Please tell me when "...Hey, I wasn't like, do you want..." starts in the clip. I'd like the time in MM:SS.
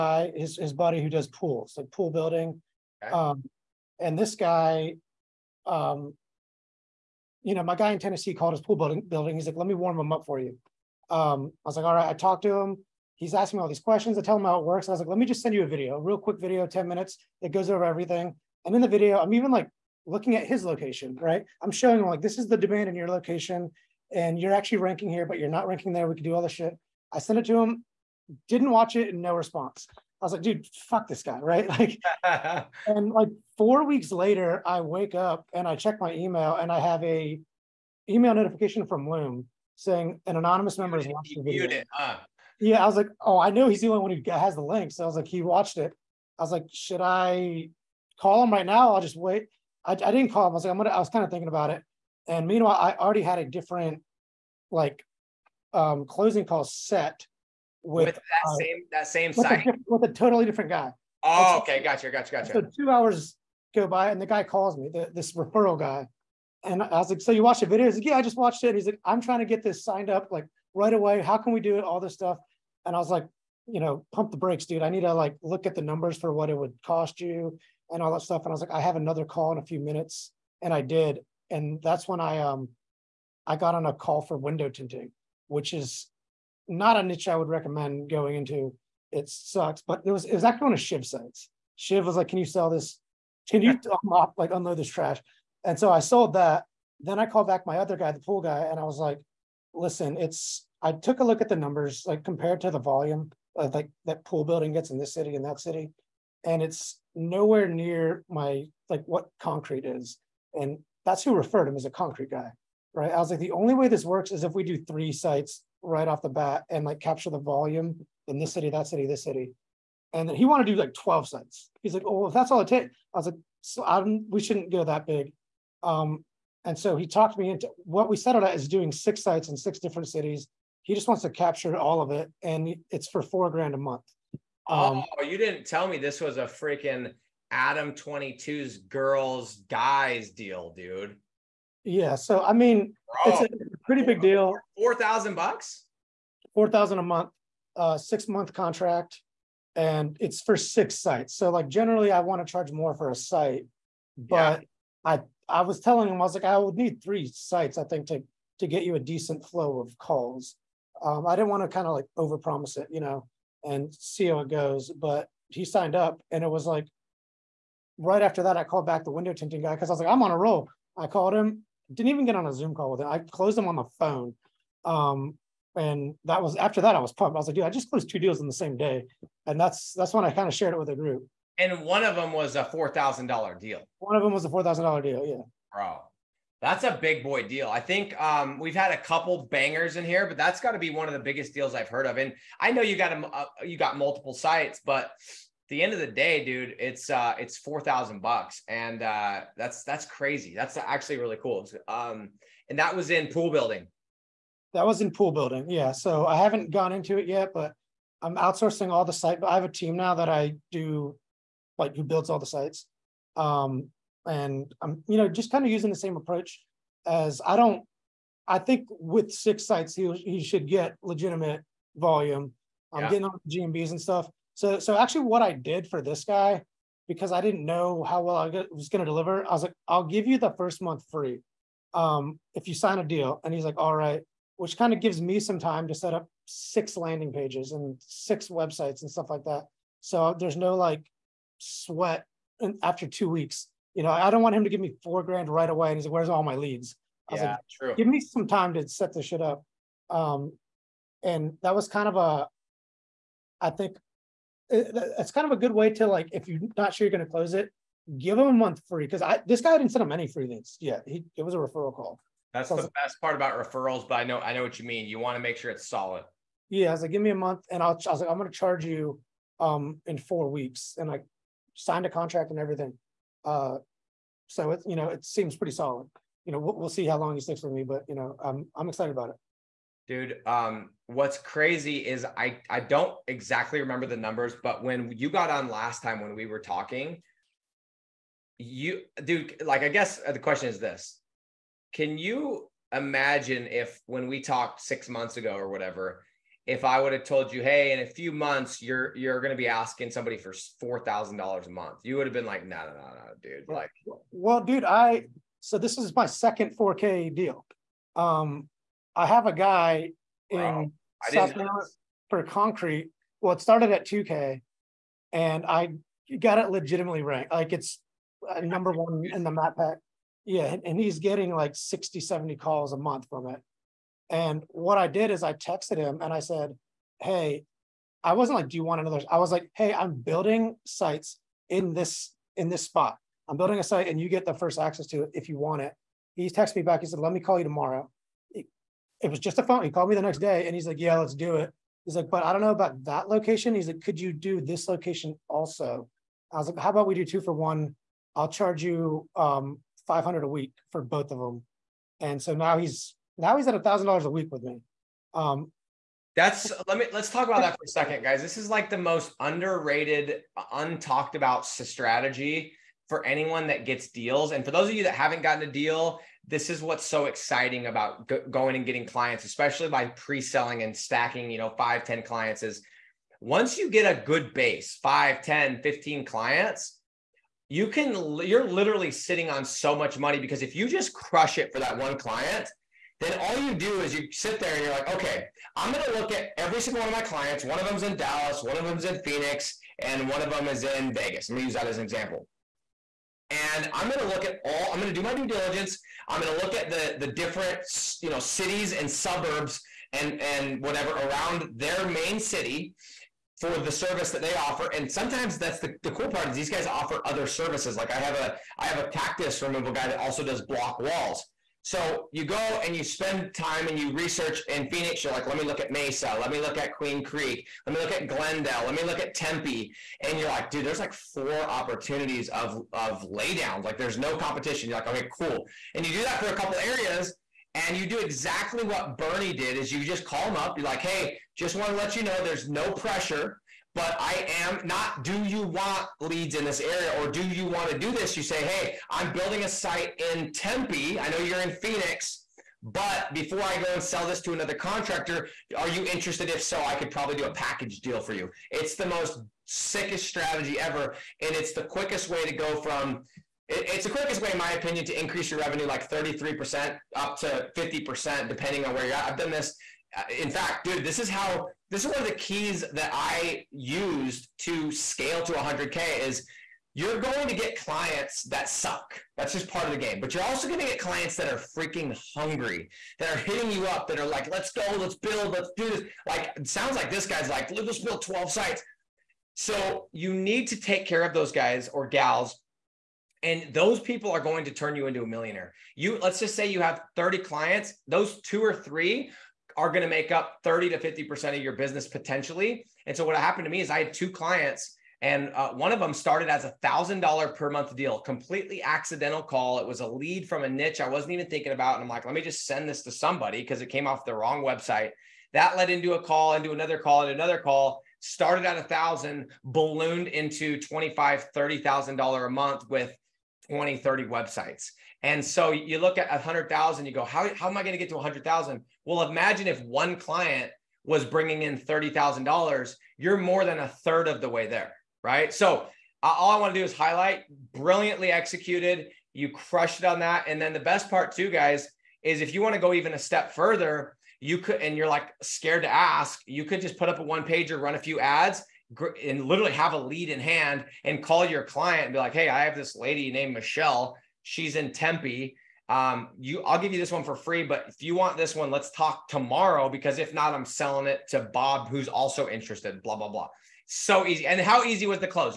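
05:27.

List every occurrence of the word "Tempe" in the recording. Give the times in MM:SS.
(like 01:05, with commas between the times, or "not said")
06:59, 07:20, 09:04.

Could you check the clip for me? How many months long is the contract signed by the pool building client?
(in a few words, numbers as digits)
6.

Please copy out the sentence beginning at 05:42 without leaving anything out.
He's like, but I don't know about that location.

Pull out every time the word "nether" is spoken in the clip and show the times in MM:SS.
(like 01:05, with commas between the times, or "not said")
not said.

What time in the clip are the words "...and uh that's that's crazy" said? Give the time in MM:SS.
03:18.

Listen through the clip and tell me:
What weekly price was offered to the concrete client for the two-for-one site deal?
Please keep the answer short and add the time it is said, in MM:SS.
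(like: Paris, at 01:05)
$500, at 05:50.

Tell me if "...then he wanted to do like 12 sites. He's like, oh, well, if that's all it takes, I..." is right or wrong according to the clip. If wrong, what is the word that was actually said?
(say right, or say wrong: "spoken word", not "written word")
right.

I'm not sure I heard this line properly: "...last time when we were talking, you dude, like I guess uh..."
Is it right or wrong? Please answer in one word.
right.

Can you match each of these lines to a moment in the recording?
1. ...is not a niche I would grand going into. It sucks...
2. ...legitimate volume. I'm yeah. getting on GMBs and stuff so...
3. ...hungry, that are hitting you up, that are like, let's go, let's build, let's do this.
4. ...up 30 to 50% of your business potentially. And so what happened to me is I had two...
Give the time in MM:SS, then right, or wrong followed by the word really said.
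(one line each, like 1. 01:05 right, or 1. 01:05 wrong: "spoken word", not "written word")
1. 01:25 wrong: "recommend", not "grand"
2. 03:41 right
3. 07:52 right
4. 08:10 right.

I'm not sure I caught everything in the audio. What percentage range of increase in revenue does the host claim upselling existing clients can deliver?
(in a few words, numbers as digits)
33% to 50%.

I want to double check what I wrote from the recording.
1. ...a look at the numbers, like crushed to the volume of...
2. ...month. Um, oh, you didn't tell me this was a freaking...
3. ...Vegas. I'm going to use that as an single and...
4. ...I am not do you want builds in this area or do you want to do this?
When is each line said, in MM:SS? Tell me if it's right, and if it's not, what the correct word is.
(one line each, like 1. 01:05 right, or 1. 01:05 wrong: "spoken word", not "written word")
1. 01:41 wrong: "compared", not "crushed"
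2. 02:13 right
3. 06:31 wrong: "example", not "single"
4. 07:14 wrong: "leads", not "builds".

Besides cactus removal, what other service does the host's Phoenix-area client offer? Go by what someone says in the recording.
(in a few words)
Block walls.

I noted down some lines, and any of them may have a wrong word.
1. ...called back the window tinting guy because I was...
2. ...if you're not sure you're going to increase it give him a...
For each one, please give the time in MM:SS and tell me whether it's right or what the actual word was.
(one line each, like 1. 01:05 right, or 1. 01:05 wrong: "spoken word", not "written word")
1. 02:48 right
2. 04:16 wrong: "close", not "increase".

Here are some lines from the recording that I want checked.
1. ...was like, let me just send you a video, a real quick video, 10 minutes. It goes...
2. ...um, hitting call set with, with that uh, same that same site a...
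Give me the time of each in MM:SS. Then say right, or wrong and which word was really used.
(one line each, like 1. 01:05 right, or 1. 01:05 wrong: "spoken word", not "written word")
1. 00:14 right
2. 00:55 wrong: "closing", not "hitting".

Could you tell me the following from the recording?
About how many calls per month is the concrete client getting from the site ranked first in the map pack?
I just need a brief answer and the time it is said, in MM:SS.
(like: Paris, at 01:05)
60 to 70, at 05:21.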